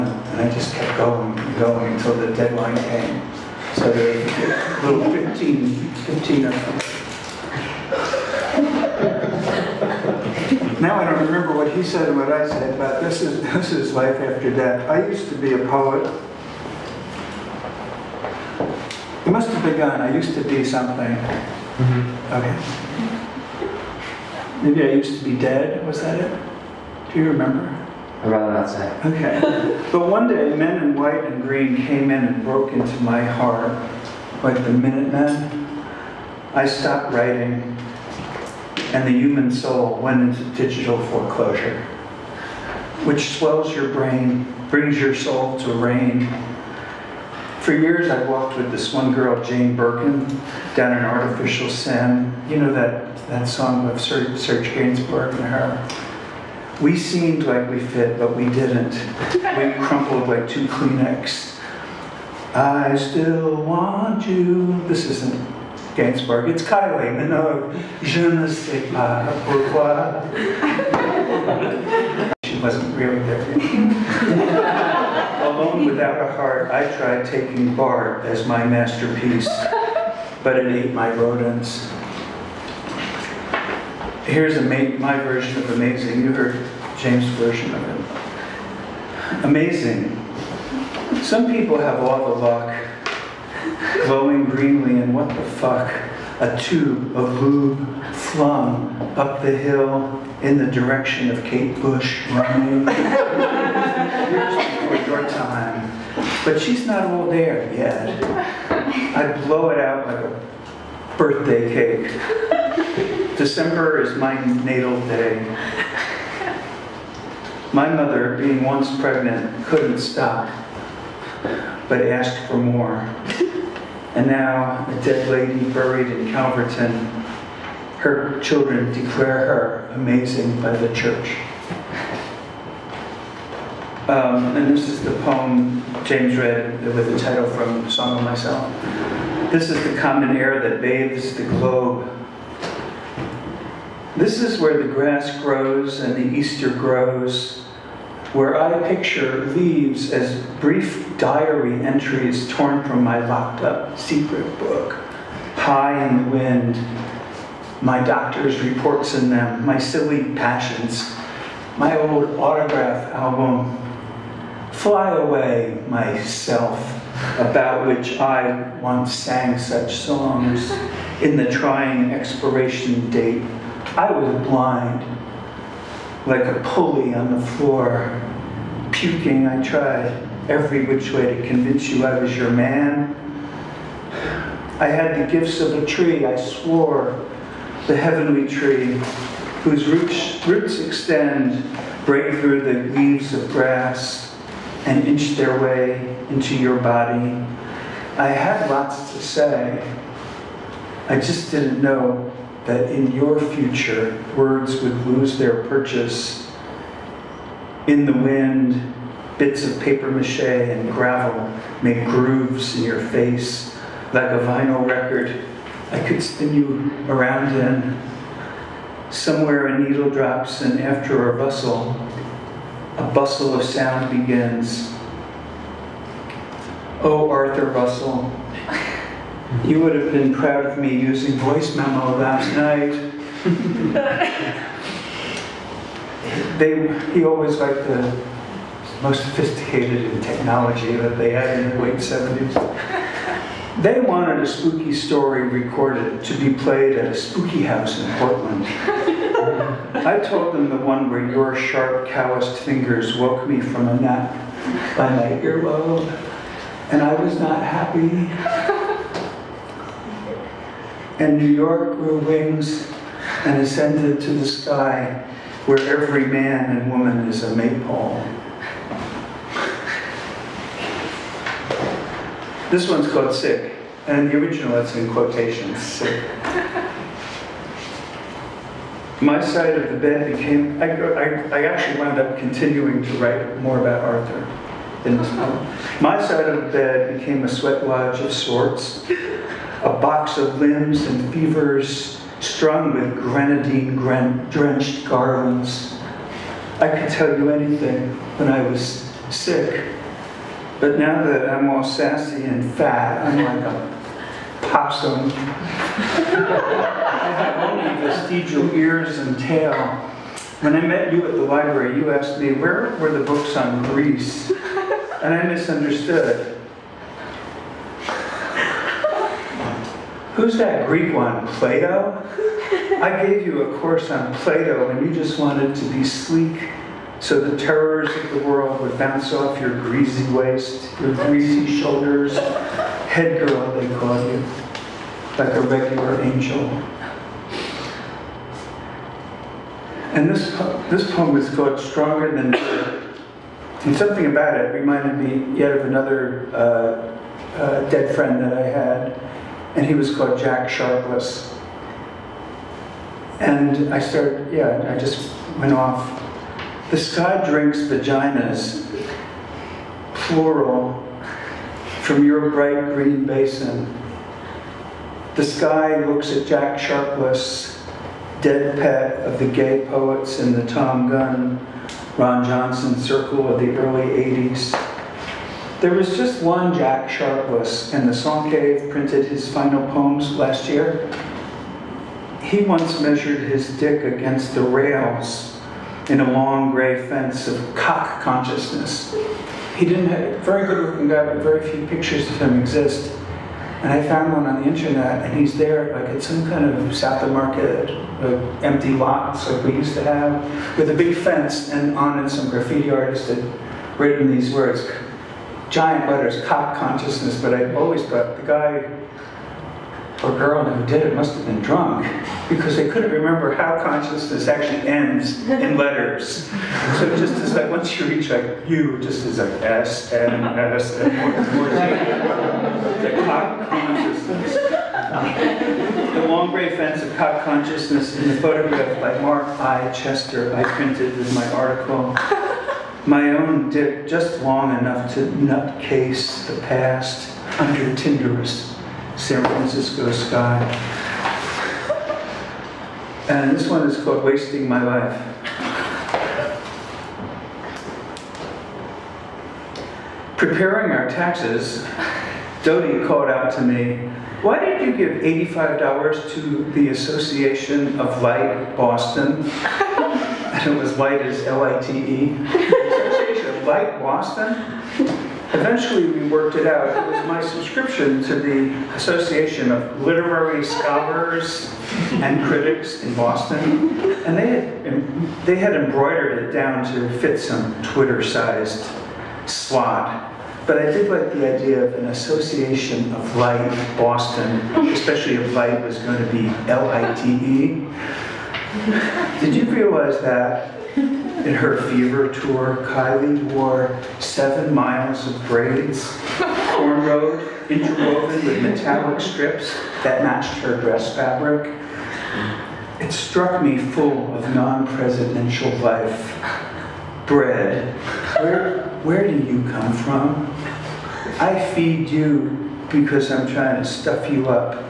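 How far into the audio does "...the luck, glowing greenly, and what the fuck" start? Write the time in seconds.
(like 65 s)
92 s.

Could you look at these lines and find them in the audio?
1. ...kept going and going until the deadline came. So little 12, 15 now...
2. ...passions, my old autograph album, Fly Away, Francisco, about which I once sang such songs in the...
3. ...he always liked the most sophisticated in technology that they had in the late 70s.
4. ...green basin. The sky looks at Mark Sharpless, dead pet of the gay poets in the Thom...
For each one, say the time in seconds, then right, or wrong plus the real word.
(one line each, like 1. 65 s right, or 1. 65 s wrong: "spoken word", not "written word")
1. 0 s wrong: "15", not "12"
2. 160 s wrong: "Myself", not "Francisco"
3. 237 s right
4. 362 s wrong: "Jack", not "Mark".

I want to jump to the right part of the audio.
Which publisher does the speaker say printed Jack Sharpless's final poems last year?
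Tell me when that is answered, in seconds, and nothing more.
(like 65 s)
378 s.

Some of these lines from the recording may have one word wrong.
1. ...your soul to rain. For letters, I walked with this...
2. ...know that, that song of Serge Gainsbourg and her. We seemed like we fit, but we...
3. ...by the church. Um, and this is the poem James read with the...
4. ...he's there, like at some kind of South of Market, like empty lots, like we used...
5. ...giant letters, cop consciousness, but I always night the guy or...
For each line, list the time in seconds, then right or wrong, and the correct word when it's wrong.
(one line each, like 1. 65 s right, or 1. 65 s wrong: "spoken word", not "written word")
1. 44 s wrong: "years", not "letters"
2. 52 s right
3. 130 s right
4. 395 s right
5. 405 s wrong: "thought", not "night".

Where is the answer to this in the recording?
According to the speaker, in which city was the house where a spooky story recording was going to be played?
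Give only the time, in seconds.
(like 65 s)
248 s.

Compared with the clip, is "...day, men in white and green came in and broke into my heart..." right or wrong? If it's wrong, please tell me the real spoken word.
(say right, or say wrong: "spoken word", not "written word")
right.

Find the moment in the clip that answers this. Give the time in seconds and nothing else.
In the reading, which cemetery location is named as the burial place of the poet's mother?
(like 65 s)
126 s.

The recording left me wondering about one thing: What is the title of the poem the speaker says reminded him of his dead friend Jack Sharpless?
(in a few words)
Stronger Than Dirt.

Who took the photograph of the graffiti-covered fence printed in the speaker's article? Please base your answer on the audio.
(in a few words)
Mark I. Chester.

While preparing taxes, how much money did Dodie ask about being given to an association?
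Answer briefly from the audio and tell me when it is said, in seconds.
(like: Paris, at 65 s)
$85, at 455 s.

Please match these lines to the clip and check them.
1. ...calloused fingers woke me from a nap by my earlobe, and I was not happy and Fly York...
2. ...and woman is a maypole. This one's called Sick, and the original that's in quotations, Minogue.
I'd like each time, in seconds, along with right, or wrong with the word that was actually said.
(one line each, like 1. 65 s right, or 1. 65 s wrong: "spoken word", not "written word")
1. 252 s wrong: "New", not "Fly"
2. 266 s wrong: "Sick", not "Minogue".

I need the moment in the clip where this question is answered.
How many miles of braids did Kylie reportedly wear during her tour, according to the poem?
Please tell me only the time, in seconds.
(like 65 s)
494 s.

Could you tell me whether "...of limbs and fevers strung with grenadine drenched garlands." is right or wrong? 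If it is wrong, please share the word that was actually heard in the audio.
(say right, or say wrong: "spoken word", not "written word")
right.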